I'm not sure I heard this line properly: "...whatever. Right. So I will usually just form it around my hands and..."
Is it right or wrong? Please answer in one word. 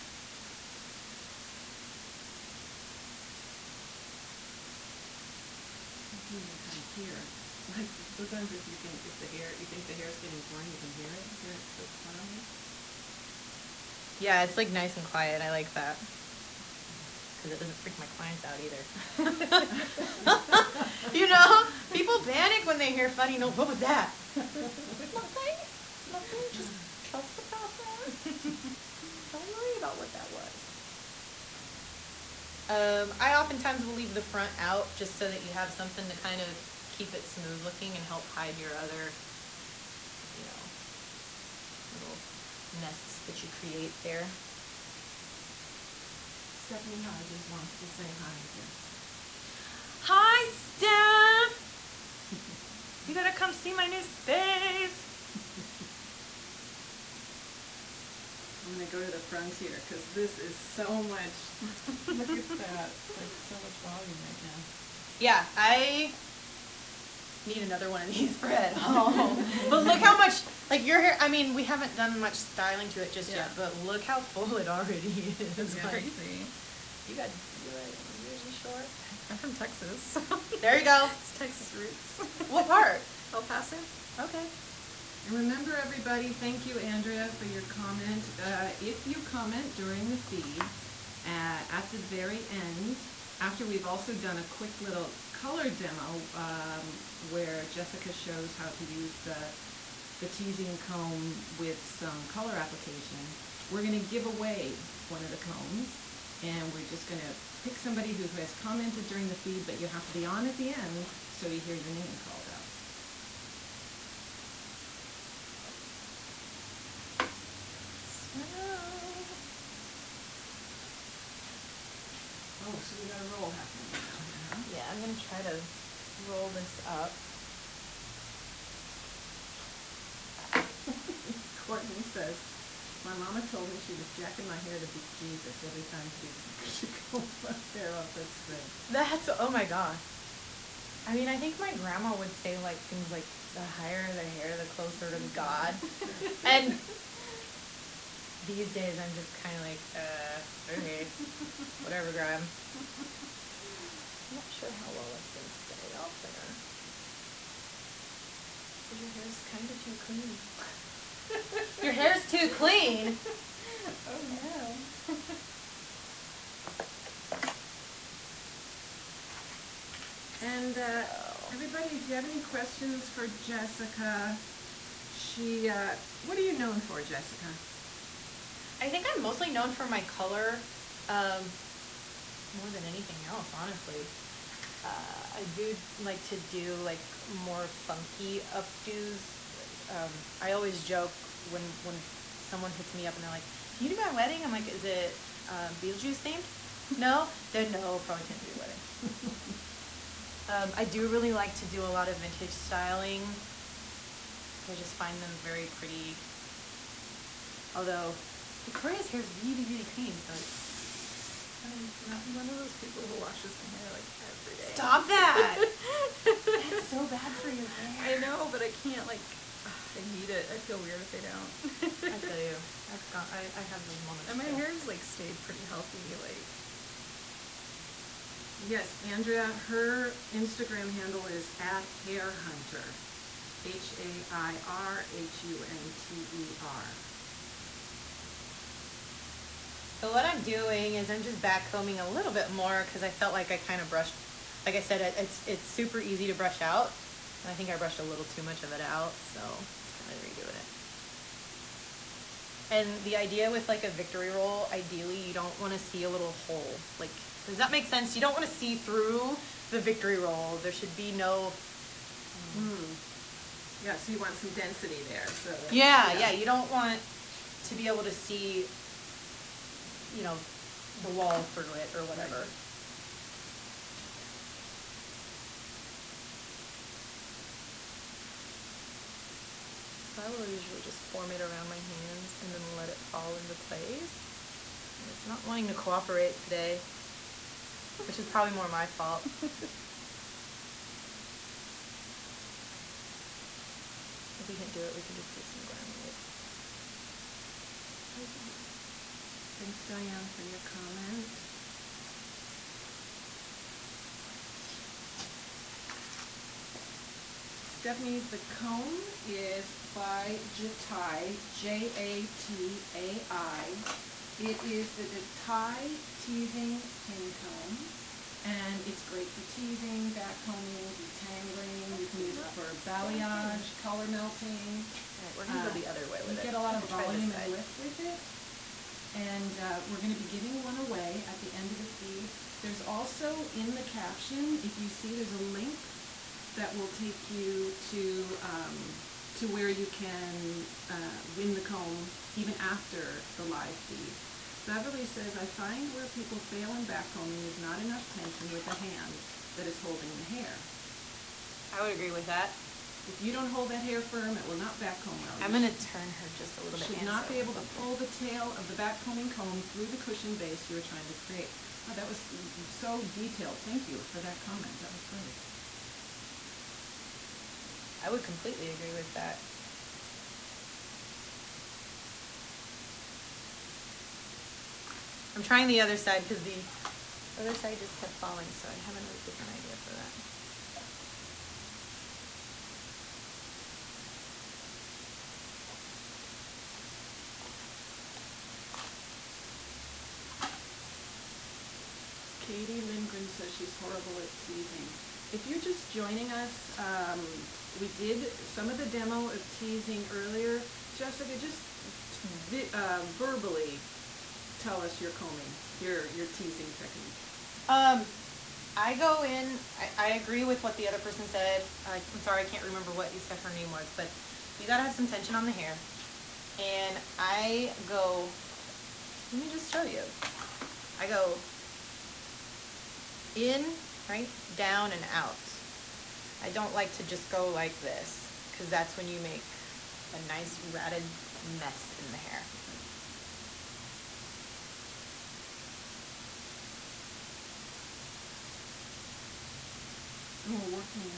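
right.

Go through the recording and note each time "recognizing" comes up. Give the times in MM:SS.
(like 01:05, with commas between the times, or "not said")
not said.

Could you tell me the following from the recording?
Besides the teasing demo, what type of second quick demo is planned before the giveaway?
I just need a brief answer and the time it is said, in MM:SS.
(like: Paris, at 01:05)
color demo, at 01:35.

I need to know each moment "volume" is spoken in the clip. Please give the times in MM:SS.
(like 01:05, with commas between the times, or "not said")
01:03, 05:26.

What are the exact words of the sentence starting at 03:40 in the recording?
I feel weird if I don't.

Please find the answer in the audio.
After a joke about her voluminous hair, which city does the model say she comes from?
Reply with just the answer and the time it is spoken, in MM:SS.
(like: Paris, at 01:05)
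El Paso, at 01:23.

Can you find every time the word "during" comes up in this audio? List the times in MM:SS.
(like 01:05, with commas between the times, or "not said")
01:29, 01:49.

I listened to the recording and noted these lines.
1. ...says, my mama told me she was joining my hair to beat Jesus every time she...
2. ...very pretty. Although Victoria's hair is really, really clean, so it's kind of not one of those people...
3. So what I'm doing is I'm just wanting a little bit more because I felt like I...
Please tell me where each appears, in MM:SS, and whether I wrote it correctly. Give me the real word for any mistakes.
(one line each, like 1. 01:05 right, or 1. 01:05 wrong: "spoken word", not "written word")
1. 02:12 wrong: "jacking", not "joining"
2. 03:25 right
3. 04:00 wrong: "backcombing", not "wanting".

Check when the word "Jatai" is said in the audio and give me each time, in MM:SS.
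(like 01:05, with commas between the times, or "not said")
05:10, 05:15.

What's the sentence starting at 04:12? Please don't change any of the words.
And the idea with like a victory roll, ideally you don't want to see a little hole.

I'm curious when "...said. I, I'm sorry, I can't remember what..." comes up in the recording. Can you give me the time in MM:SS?
06:51.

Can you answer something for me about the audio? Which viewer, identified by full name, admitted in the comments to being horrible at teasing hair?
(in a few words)
Katie Lindgren.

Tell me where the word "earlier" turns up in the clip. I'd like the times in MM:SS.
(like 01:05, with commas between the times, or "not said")
06:40.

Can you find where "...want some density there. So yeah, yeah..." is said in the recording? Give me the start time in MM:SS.
04:24.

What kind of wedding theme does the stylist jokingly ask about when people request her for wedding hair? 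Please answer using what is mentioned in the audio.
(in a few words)
Beetlejuice.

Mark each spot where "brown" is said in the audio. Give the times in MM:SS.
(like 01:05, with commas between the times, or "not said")
not said.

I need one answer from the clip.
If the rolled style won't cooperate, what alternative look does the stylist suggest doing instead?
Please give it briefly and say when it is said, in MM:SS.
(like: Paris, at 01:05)
glam waves, at 04:55.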